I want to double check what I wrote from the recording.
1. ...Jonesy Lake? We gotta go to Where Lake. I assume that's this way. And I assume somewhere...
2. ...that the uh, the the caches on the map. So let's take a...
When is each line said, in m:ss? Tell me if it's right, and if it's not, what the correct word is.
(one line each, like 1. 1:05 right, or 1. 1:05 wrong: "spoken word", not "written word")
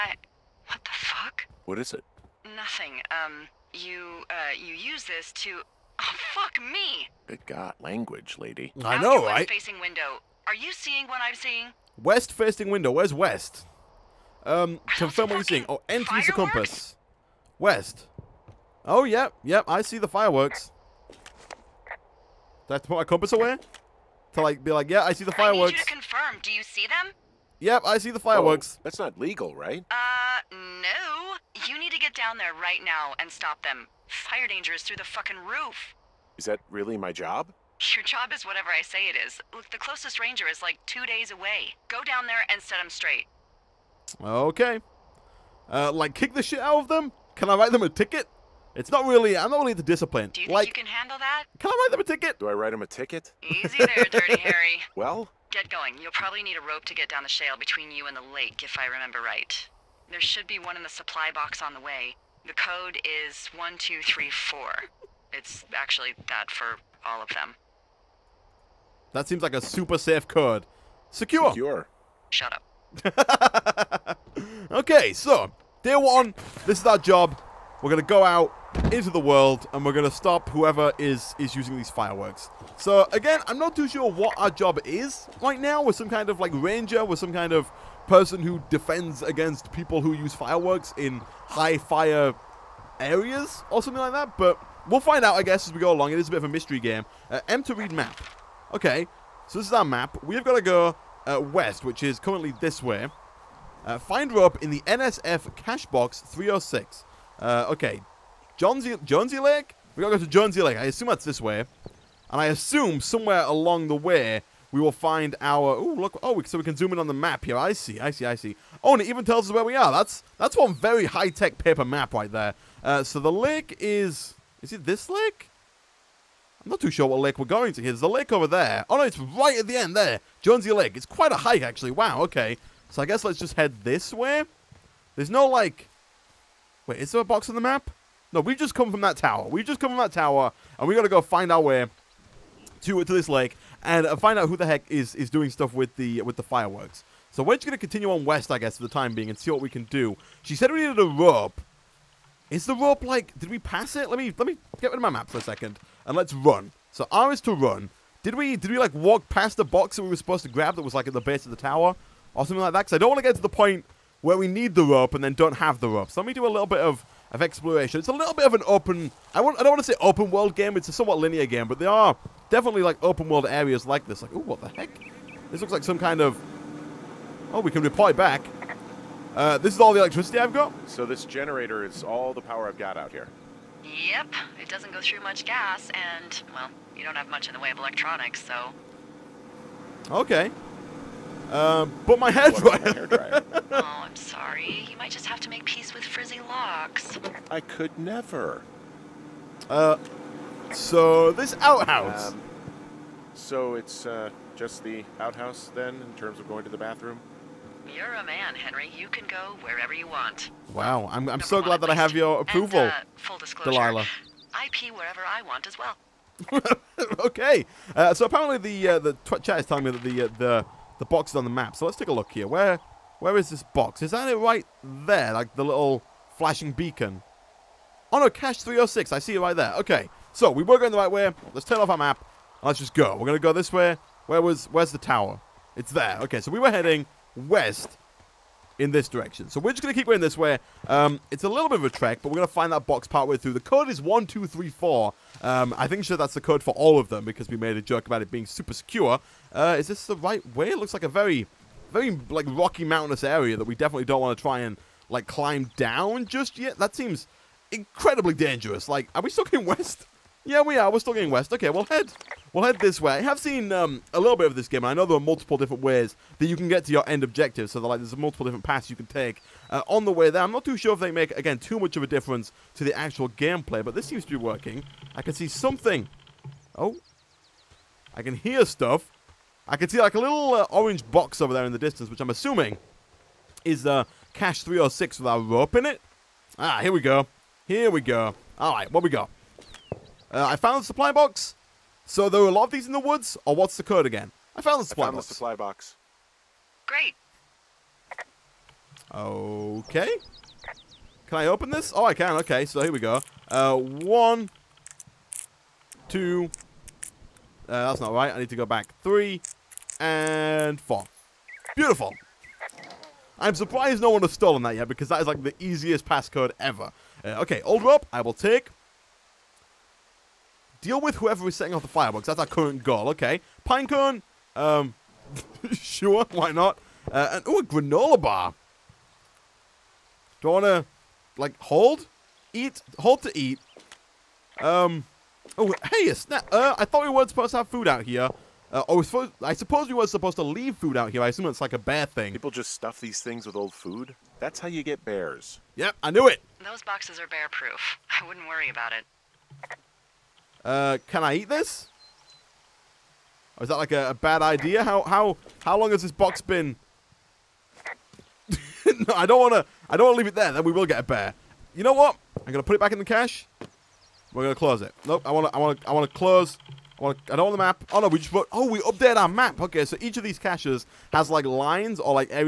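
1. 1:49 wrong: "Jonesy", not "Where"
2. 3:39 wrong: "boxes", not "caches".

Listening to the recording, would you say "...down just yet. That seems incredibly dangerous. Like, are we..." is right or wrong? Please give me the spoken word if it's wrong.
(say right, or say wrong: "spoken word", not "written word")
right.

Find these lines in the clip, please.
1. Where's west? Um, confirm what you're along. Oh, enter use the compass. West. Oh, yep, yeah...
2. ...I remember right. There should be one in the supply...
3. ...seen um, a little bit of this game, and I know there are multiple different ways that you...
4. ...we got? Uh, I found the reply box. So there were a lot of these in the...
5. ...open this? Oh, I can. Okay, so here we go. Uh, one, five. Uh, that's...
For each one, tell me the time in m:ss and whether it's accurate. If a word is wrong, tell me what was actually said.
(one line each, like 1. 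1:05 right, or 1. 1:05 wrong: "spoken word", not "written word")
1. 0:12 wrong: "seeing", not "along"
2. 0:58 right
3. 4:23 right
4. 4:49 wrong: "supply", not "reply"
5. 5:01 wrong: "two", not "five".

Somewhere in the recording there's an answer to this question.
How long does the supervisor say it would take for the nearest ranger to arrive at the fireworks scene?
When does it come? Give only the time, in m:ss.
0:40.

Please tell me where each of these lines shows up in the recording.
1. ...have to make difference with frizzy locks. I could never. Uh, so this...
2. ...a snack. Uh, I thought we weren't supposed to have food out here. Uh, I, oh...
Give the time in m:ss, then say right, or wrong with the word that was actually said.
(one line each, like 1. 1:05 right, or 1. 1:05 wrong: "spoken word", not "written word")
1. 3:15 wrong: "peace", not "difference"
2. 5:36 right.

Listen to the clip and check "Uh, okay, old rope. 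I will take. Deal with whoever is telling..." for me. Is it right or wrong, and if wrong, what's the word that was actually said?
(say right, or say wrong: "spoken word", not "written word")
wrong: "setting", not "telling".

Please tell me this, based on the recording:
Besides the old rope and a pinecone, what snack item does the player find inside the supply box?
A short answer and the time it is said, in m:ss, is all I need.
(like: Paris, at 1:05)
Granola bar, at 5:27.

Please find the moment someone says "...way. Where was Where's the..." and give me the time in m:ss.
3:53.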